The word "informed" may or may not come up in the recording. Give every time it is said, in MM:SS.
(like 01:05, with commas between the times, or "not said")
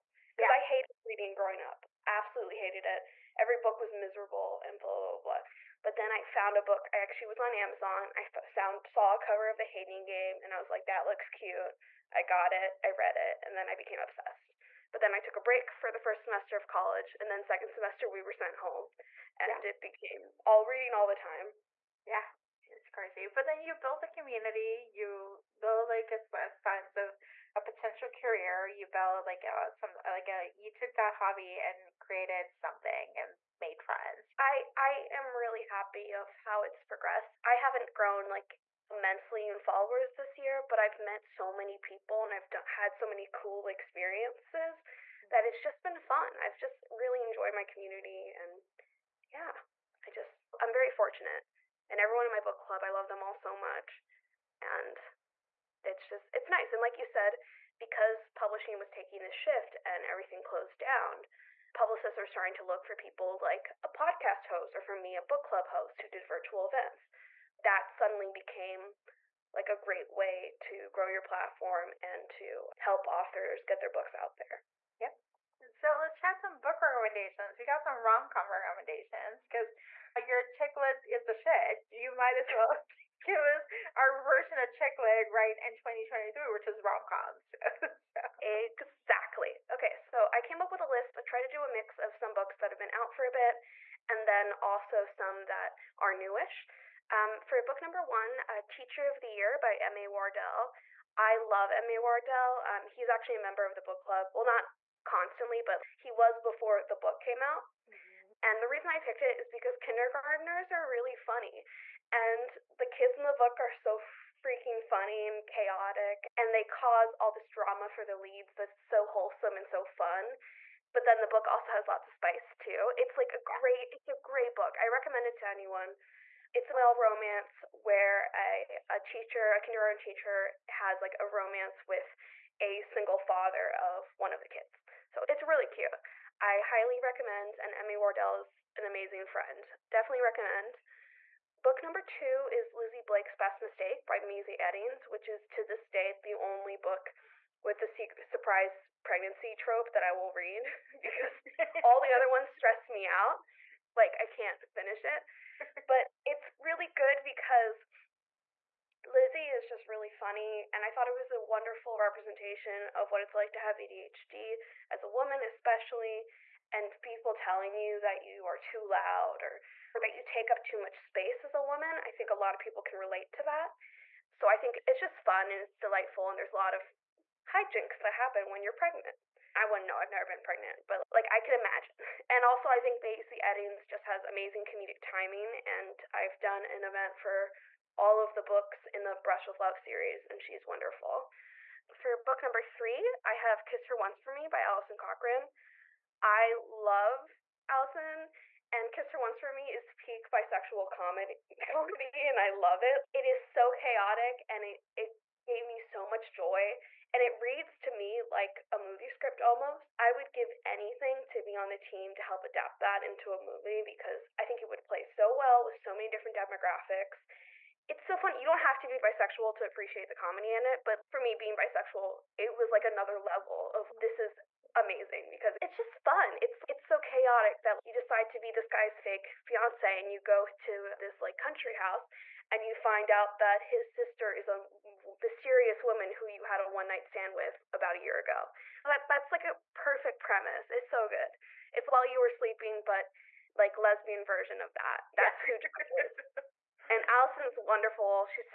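not said.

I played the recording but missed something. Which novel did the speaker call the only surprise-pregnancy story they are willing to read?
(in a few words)
Lizzie Blake's Best Mistake.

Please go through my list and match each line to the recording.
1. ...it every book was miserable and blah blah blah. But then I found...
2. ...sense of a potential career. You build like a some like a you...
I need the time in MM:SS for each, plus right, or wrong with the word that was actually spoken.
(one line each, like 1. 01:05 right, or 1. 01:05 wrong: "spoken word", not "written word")
1. 00:02 right
2. 00:26 right.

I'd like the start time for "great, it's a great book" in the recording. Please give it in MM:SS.
02:03.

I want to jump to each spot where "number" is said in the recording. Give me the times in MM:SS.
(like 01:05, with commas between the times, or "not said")
01:37, 02:21, 03:12.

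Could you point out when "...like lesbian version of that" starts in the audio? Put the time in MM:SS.
04:03.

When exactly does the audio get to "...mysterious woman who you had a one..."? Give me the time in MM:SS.
03:55.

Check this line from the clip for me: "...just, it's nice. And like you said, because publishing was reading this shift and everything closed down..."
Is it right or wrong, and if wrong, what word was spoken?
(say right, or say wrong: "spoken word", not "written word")
wrong: "taking", not "reading".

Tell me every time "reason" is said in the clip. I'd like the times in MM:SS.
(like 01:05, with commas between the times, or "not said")
01:48.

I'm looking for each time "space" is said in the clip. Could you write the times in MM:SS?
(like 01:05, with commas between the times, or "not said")
02:50.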